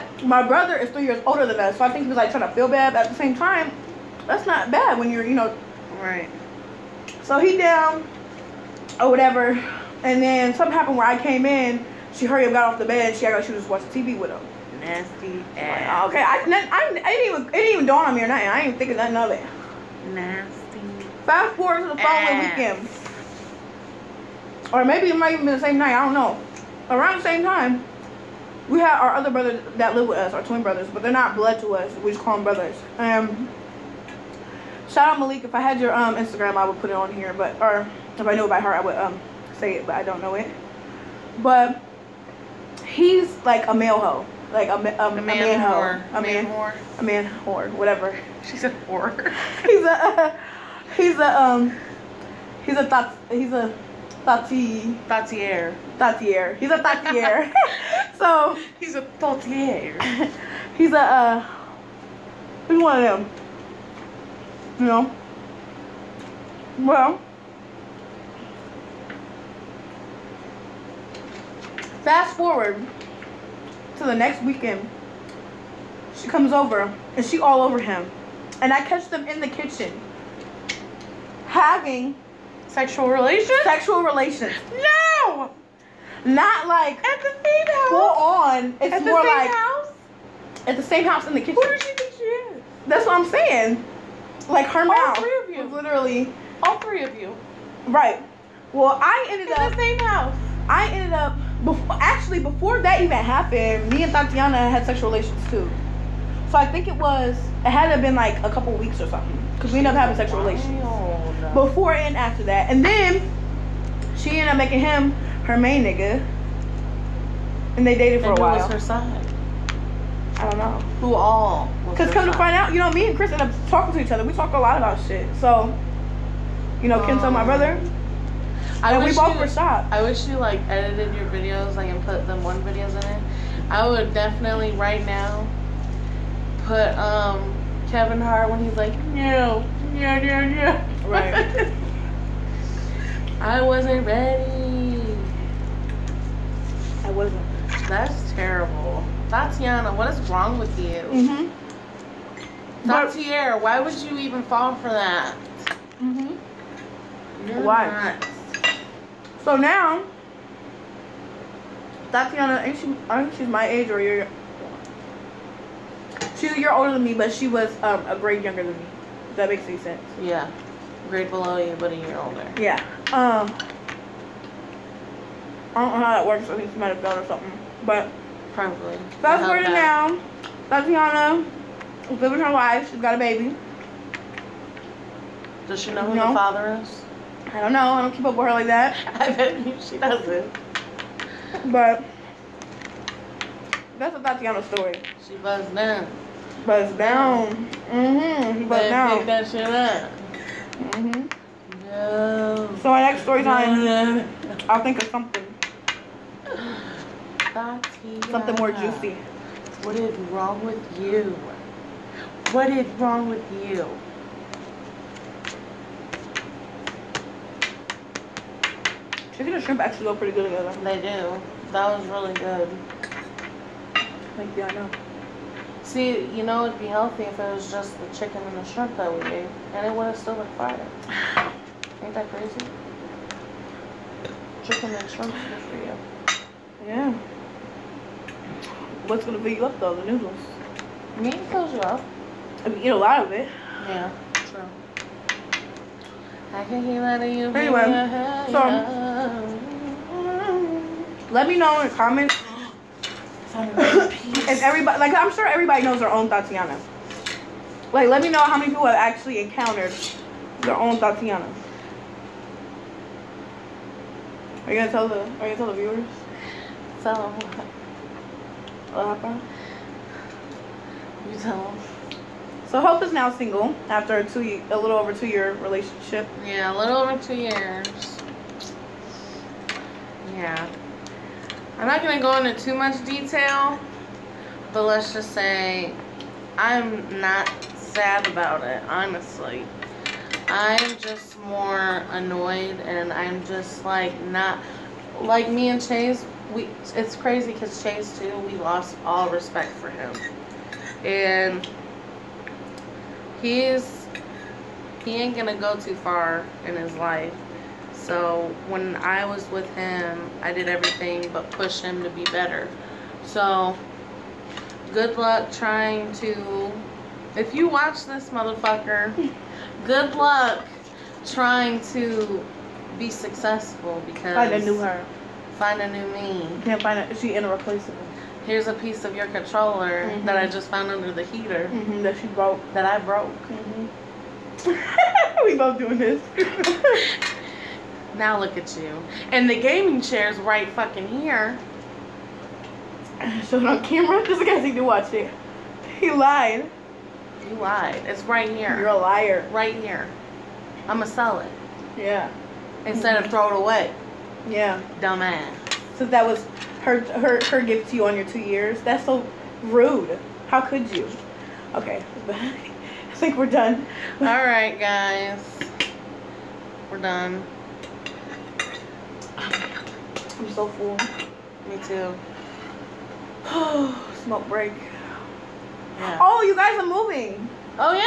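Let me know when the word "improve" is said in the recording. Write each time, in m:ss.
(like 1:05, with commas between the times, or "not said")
not said.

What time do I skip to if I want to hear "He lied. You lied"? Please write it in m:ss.
5:45.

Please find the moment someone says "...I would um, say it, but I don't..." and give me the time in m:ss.
0:38.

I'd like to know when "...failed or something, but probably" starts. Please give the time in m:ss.
2:56.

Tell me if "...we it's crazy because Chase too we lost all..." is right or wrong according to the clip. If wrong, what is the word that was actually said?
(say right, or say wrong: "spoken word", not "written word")
right.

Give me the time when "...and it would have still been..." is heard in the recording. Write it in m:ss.
3:49.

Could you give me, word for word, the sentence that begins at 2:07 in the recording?
Um, I and we both you, were I wish you like edited your videos like and put them one videos in it.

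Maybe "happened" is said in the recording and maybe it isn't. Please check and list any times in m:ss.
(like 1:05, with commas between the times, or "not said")
0:10, 1:43, 4:29.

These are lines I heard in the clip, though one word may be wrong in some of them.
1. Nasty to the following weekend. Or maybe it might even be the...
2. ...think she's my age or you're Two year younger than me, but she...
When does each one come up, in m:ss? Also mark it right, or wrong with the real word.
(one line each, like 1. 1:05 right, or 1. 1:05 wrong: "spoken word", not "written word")
1. 0:20 right
2. 2:43 wrong: "older", not "younger".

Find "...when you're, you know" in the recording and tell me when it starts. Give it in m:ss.
0:04.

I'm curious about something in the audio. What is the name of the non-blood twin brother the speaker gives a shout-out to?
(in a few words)
Malik.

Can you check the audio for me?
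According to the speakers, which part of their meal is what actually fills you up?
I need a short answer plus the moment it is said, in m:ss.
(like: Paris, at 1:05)
The noodles, at 3:59.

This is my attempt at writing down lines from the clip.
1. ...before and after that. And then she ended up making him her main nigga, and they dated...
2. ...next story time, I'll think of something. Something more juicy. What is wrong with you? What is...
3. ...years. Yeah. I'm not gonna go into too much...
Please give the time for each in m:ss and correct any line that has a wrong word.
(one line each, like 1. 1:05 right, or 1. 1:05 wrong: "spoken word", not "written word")
1. 1:51 right
2. 3:23 right
3. 4:37 right.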